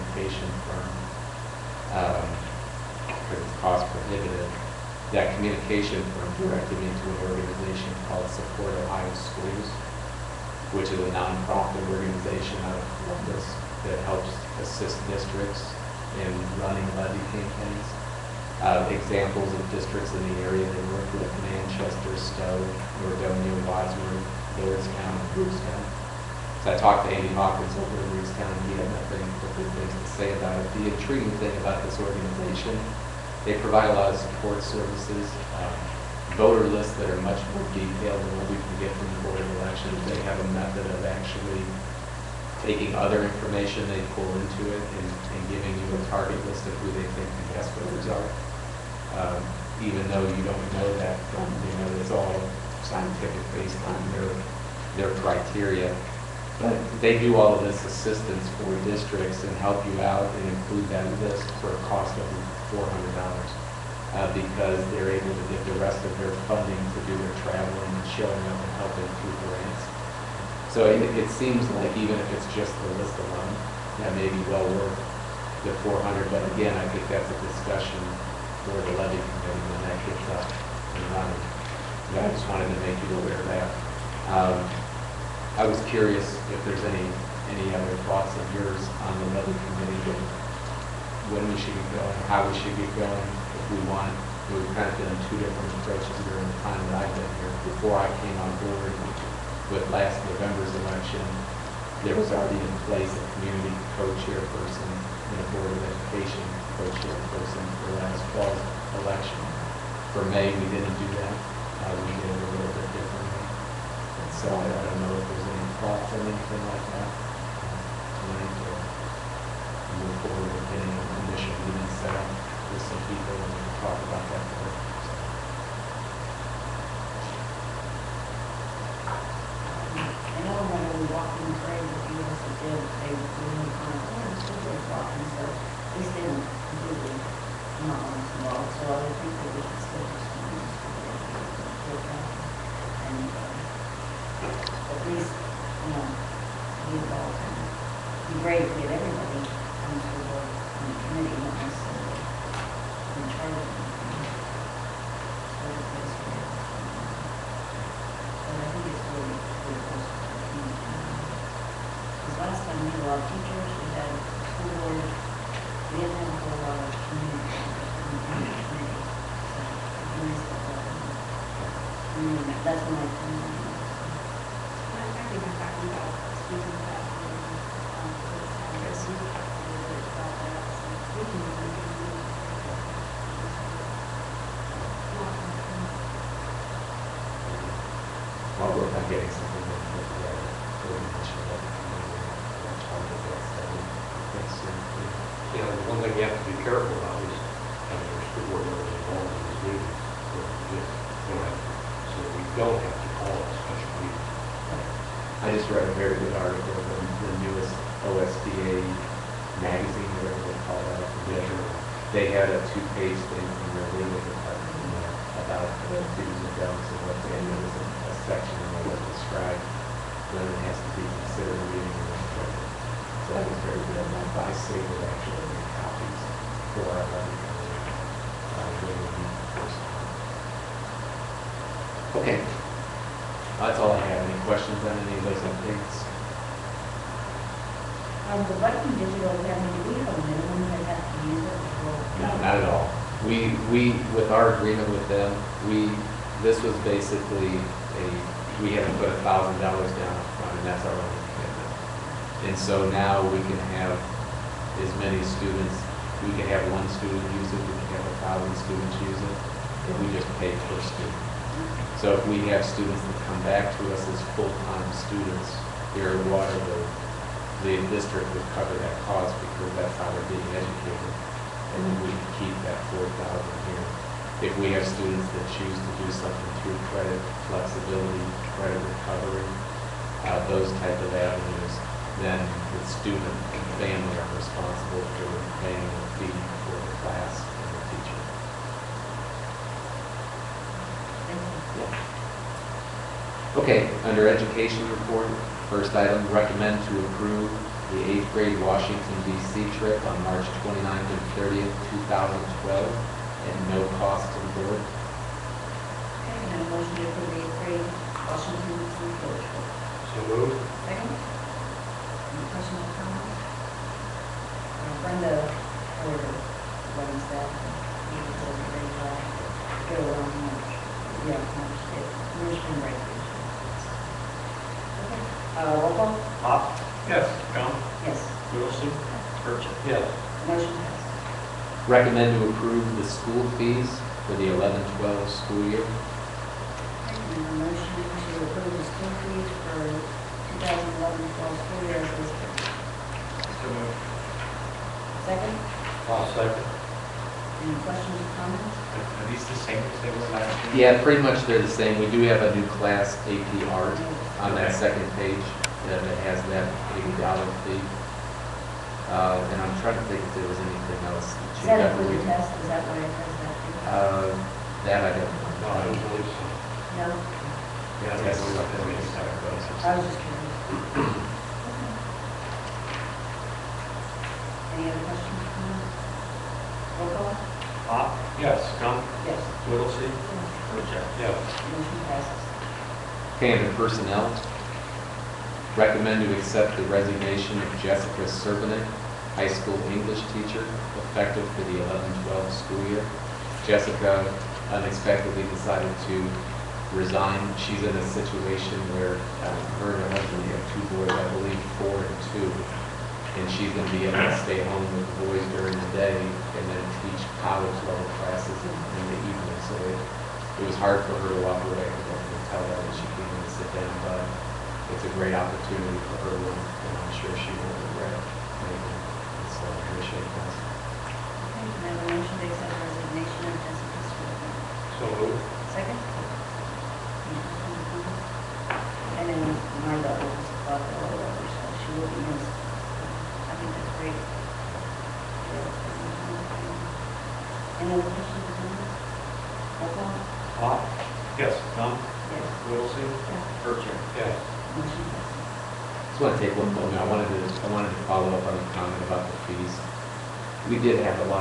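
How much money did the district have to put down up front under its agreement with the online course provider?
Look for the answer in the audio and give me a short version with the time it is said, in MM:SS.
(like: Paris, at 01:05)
$1,000, at 04:09.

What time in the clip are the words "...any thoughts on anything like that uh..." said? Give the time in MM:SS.
01:55.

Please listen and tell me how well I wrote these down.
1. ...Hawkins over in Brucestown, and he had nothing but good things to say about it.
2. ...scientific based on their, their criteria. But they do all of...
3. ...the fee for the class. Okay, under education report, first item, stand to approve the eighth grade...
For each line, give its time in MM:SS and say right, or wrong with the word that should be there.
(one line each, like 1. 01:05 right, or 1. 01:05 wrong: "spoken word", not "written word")
1. 00:27 right
2. 00:52 right
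3. 04:45 wrong: "recommend", not "stand".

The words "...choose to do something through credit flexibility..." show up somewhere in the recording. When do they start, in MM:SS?
04:35.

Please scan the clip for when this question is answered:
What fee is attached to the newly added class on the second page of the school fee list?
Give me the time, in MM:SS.
05:56.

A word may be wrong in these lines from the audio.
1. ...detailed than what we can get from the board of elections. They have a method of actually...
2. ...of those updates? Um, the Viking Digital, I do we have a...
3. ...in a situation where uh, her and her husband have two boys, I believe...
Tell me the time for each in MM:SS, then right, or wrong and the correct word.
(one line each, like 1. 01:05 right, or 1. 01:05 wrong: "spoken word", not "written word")
1. 00:37 right
2. 03:55 right
3. 06:37 right.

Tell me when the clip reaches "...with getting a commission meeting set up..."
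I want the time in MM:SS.
02:00.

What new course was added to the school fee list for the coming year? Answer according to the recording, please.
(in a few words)
AP Art.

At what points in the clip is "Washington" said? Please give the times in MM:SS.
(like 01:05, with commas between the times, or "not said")
04:58, 05:08.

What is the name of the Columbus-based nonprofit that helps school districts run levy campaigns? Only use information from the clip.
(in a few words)
Support Ohio Schools.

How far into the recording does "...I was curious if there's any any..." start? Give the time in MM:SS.
01:25.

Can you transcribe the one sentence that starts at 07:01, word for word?
I have a motion to accept resignation of Jessica Stewart.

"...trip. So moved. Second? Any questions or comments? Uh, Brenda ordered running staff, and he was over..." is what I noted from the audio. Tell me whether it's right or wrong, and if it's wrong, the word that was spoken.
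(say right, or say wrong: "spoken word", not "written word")
right.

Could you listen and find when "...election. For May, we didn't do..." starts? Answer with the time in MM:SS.
01:49.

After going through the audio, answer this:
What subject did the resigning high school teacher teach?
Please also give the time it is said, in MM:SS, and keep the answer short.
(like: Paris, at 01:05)
English, at 06:29.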